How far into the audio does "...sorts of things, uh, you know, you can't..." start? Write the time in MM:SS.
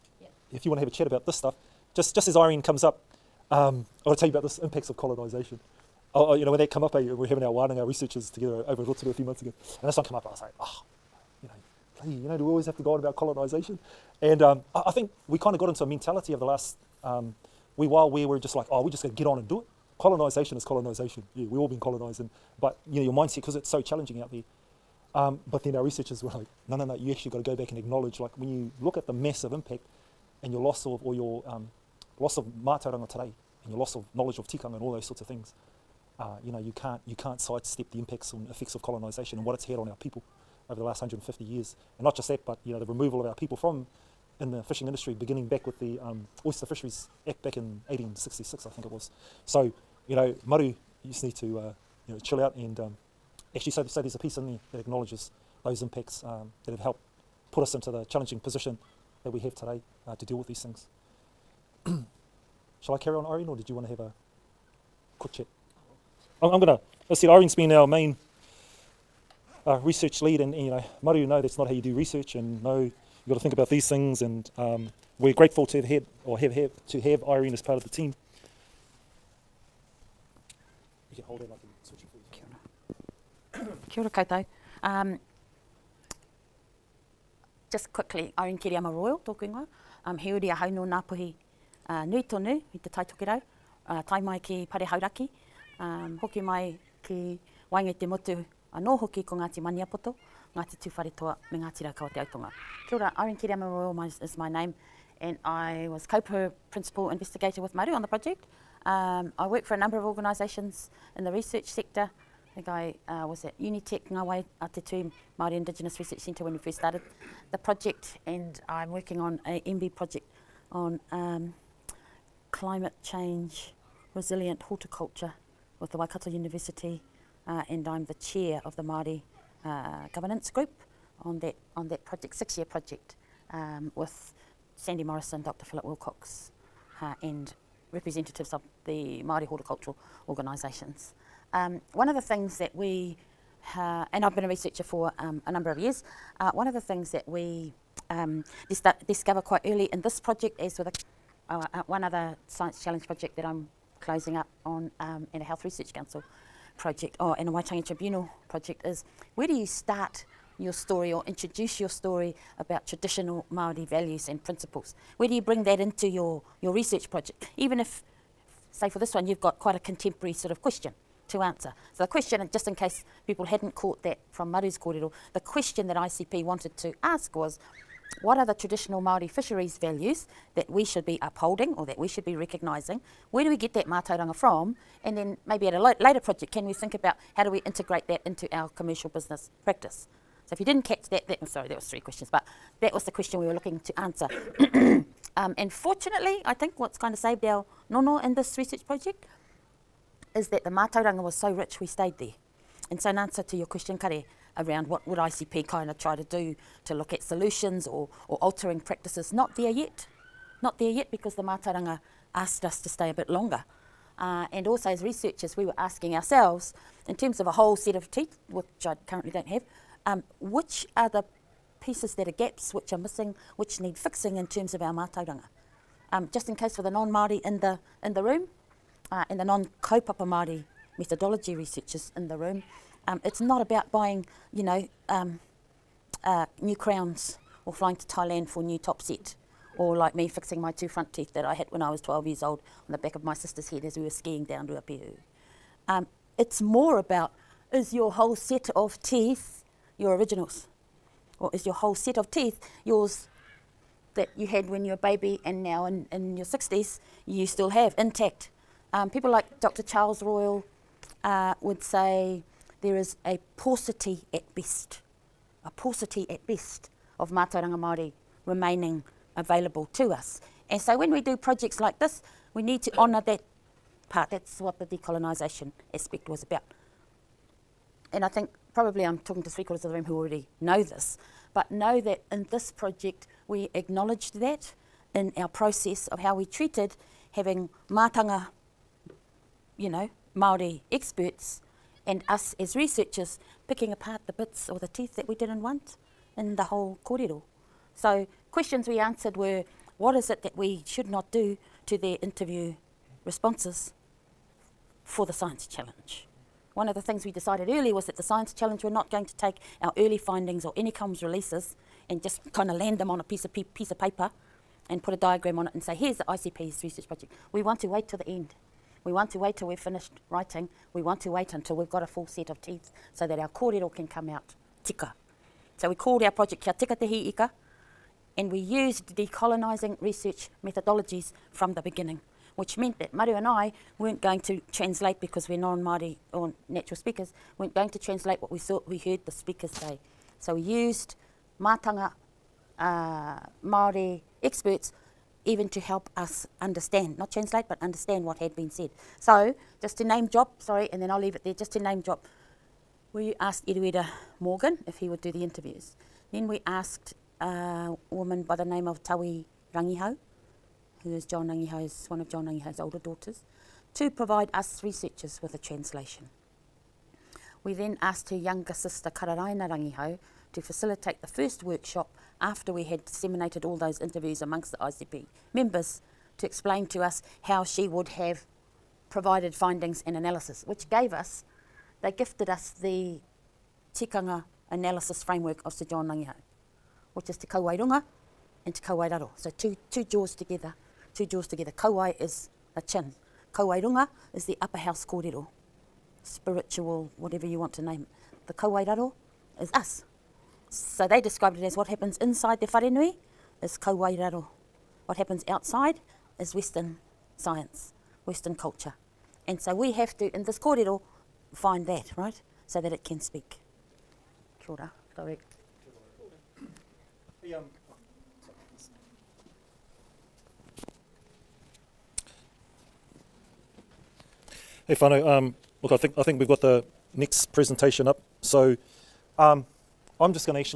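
00:35.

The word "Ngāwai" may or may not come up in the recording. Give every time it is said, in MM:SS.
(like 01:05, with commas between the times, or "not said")
01:54.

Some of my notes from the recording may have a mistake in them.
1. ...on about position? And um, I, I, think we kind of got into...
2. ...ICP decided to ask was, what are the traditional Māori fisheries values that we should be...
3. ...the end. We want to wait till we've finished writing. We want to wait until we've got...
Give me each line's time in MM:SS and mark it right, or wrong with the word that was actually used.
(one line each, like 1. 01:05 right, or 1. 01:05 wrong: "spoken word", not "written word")
1. 00:12 wrong: "colonisation", not "position"
2. 02:55 wrong: "wanted", not "decided"
3. 05:18 right.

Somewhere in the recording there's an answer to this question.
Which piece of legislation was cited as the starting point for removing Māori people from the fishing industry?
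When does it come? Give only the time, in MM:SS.
00:46.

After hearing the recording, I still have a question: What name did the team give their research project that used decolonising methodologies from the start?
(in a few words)
Kia Tika Te Hi Ika.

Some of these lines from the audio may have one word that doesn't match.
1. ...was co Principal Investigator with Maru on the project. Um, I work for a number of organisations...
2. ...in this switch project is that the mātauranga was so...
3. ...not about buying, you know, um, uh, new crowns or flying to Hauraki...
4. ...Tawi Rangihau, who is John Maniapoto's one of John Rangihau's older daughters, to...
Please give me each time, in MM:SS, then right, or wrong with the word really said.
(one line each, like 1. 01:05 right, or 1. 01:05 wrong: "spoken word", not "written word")
1. 01:45 right
2. 03:18 wrong: "research", not "switch"
3. 03:53 wrong: "Thailand", not "Hauraki"
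4. 05:59 wrong: "Rangihau", not "Maniapoto".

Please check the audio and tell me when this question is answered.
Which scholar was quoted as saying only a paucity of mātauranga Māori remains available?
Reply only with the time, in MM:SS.
04:19.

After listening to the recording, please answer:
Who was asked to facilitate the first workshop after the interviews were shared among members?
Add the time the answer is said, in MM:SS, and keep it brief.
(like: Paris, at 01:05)
Kararaina Rangihau, at 06:09.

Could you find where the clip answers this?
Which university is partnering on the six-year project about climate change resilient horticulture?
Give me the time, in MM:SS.
02:05.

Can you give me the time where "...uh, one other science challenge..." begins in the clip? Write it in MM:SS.
02:31.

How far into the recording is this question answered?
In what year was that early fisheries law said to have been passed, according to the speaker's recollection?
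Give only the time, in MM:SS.
00:47.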